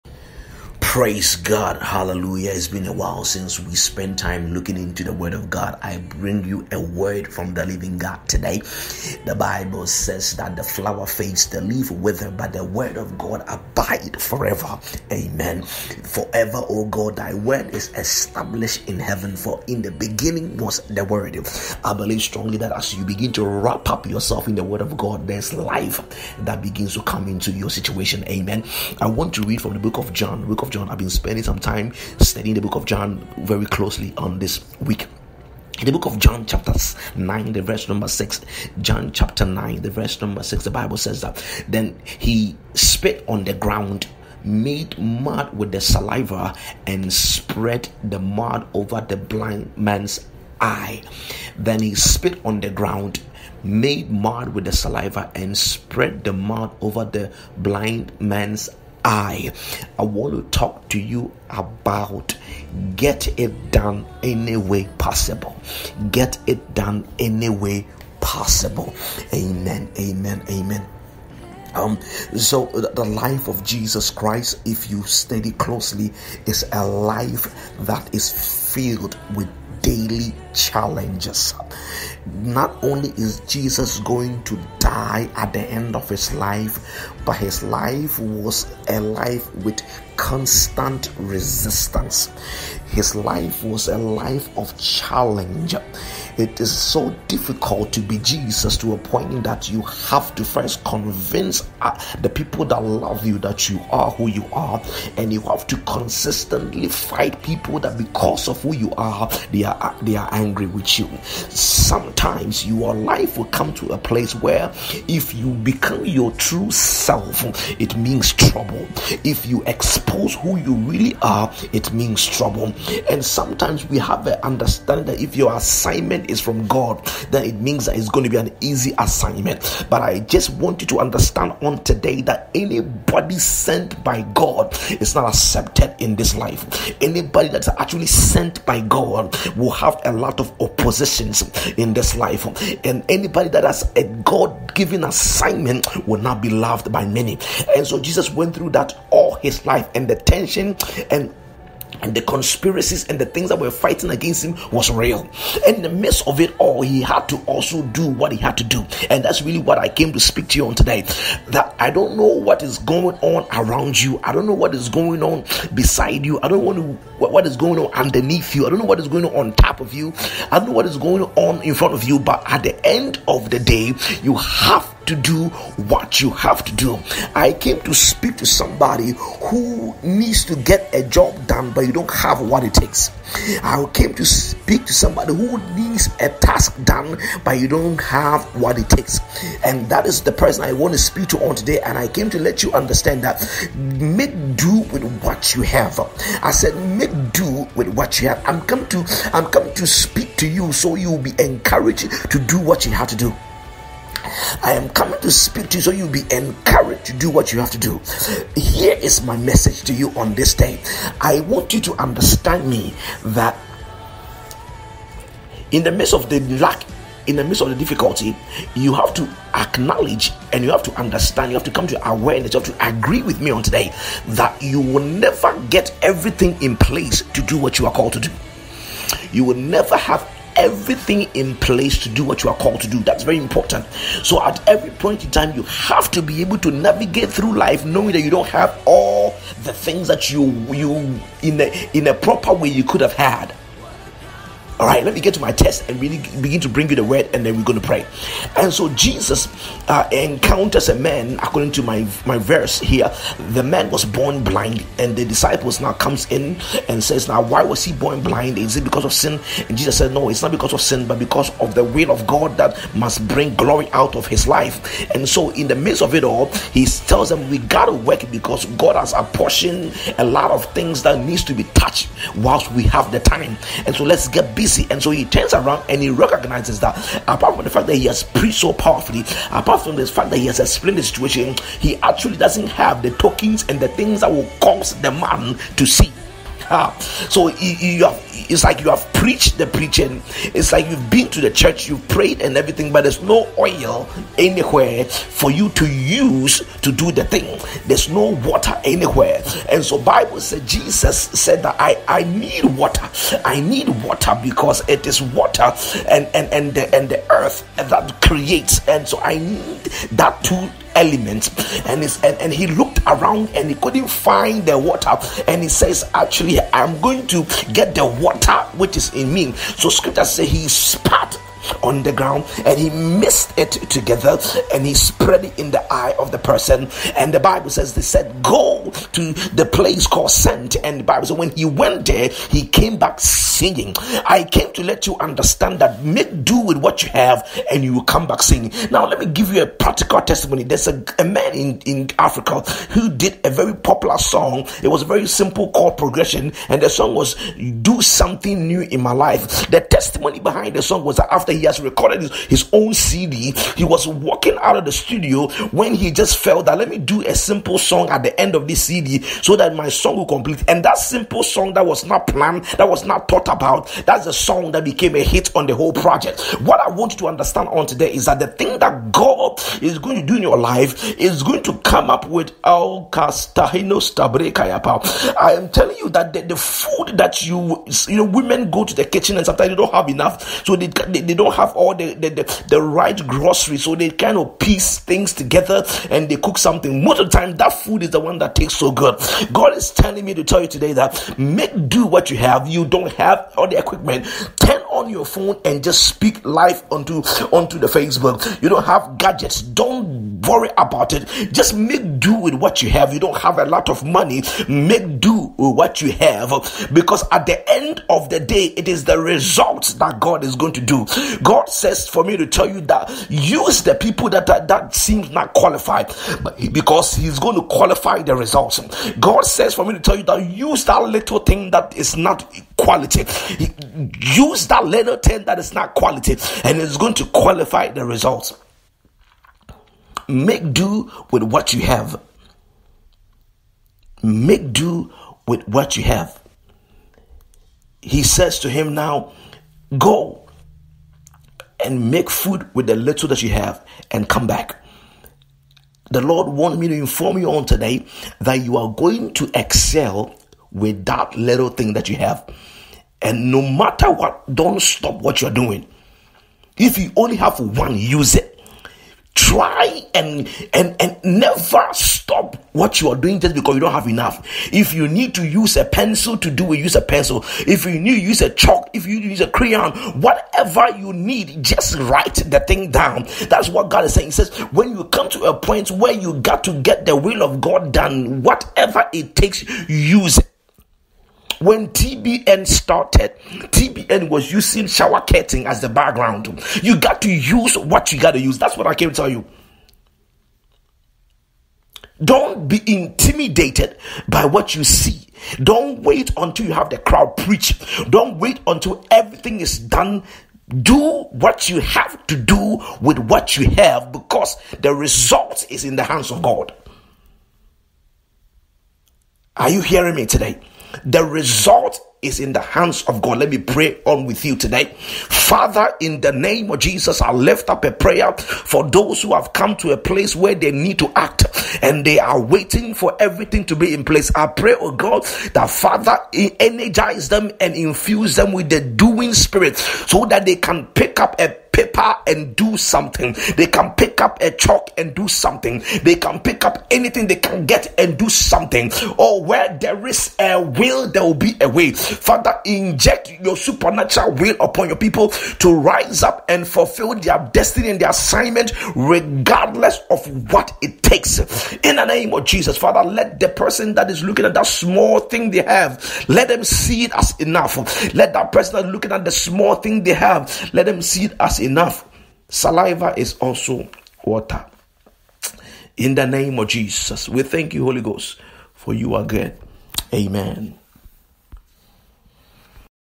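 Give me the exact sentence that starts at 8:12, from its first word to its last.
Don't be intimidated by what you see.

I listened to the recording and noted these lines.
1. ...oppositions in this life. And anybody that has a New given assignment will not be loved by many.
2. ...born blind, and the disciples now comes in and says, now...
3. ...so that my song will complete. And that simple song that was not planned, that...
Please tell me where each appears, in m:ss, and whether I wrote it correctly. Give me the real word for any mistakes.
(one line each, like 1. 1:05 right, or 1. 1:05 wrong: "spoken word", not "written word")
1. 2:20 wrong: "God", not "New"
2. 4:14 right
3. 5:59 right.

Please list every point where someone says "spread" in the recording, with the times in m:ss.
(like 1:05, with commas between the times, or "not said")
0:47, 0:55, 5:24.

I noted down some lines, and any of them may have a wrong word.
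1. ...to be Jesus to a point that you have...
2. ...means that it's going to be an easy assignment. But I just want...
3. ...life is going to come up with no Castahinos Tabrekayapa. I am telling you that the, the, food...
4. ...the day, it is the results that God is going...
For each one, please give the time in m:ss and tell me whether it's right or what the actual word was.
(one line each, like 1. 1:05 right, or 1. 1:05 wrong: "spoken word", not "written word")
1. 1:37 right
2. 2:07 right
3. 6:10 right
4. 6:48 right.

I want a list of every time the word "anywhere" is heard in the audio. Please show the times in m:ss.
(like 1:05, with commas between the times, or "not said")
4:54, 4:58.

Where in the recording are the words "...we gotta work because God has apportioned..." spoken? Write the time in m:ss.
4:27.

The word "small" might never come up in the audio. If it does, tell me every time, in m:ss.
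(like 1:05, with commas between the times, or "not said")
9:14, 9:19.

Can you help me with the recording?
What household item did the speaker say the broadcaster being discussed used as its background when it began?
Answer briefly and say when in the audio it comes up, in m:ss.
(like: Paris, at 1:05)
shower curtain, at 8:04.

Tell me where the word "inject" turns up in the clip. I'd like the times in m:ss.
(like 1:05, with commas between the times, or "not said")
9:02.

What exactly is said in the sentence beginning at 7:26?
The Lord wants me to inform you on today that you are going to excel with that little thing that you have.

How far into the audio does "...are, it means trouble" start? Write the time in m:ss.
2:01.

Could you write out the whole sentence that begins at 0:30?
I've been spending some time studying the book of John very closely on this week.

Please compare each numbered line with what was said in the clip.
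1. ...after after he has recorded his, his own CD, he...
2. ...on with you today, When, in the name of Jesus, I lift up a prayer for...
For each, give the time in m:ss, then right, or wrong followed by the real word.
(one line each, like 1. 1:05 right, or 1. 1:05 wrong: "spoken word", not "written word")
1. 5:51 right
2. 8:34 wrong: "Father", not "When".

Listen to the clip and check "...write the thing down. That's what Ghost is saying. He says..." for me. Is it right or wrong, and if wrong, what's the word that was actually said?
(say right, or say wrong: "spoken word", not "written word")
wrong: "God", not "Ghost".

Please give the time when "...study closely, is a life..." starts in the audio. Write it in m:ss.
1:15.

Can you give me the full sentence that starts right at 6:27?
Most of the time, that food is the one that tastes so good.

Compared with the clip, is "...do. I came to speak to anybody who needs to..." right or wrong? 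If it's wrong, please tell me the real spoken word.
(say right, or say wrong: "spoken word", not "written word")
wrong: "somebody", not "anybody".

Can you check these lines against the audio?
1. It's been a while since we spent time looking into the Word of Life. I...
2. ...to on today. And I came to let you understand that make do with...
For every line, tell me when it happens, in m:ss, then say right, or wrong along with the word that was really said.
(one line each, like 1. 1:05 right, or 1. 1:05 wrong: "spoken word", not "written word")
1. 0:02 wrong: "God", not "Life"
2. 3:11 right.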